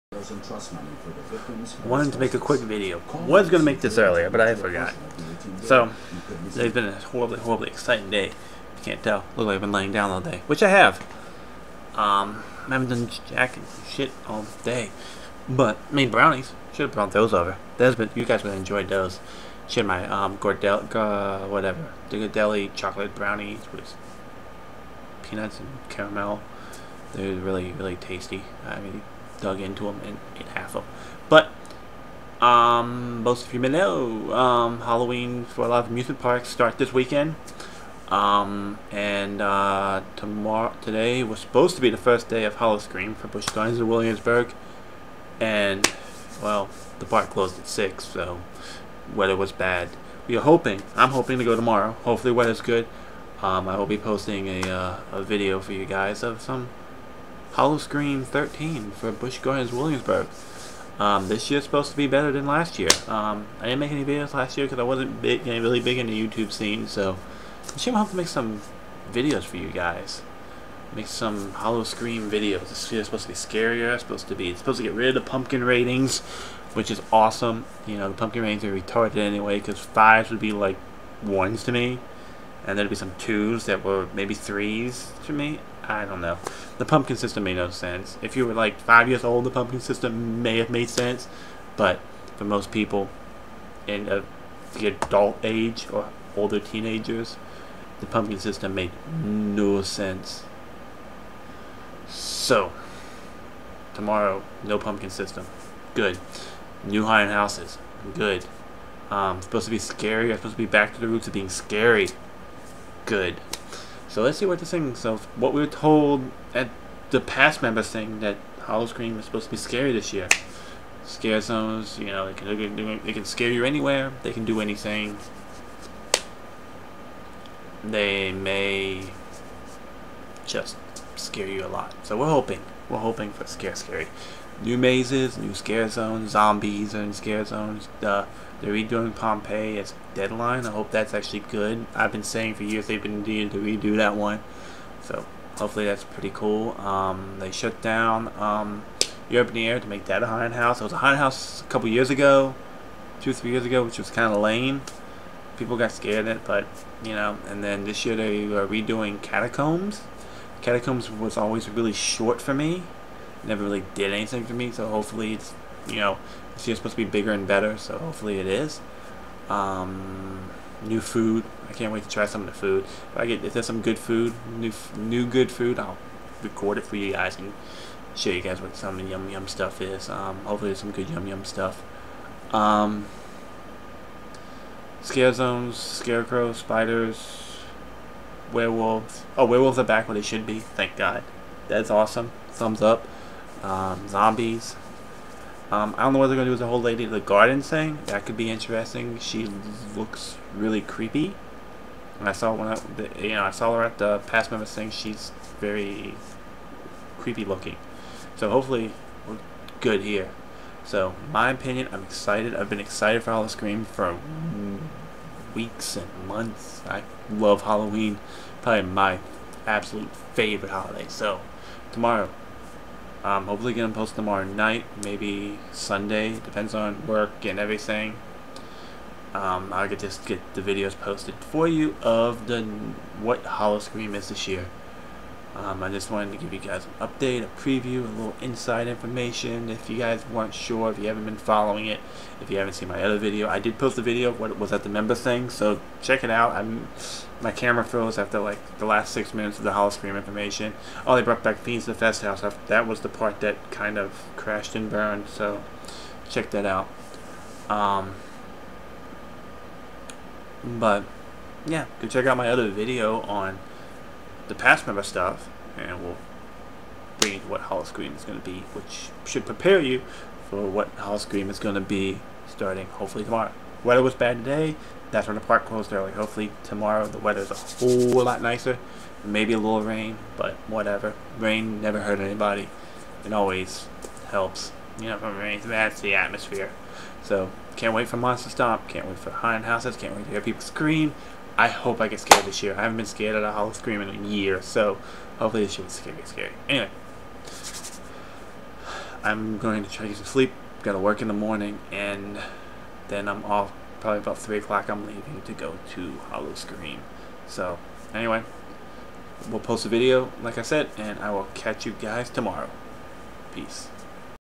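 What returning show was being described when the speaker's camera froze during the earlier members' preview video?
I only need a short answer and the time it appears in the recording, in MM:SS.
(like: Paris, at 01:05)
Fiends, at 04:11.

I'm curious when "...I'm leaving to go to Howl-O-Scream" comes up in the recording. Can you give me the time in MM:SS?
05:04.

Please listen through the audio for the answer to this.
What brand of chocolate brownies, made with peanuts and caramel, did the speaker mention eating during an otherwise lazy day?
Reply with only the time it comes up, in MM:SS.
00:22.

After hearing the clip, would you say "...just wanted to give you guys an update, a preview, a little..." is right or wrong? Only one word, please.
right.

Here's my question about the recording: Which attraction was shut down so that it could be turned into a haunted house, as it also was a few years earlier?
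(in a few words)
Europe in the Air.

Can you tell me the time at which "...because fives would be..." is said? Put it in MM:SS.
01:19.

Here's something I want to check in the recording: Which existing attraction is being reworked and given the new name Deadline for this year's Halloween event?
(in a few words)
Pompeii.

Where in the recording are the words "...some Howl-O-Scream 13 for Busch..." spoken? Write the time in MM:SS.
00:56.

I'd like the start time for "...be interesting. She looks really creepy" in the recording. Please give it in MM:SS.
03:18.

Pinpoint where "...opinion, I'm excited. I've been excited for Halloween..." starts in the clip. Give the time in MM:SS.
03:31.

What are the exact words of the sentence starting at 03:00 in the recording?
Um, hopefully there's some good yum yum stuff.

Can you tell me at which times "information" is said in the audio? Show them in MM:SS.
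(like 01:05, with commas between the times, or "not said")
03:58, 04:10.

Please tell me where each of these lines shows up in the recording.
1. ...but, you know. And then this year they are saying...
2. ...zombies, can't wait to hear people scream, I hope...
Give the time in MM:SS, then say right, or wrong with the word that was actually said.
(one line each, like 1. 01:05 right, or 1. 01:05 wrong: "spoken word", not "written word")
1. 02:36 wrong: "redoing", not "saying"
2. 04:49 wrong: "houses", not "zombies".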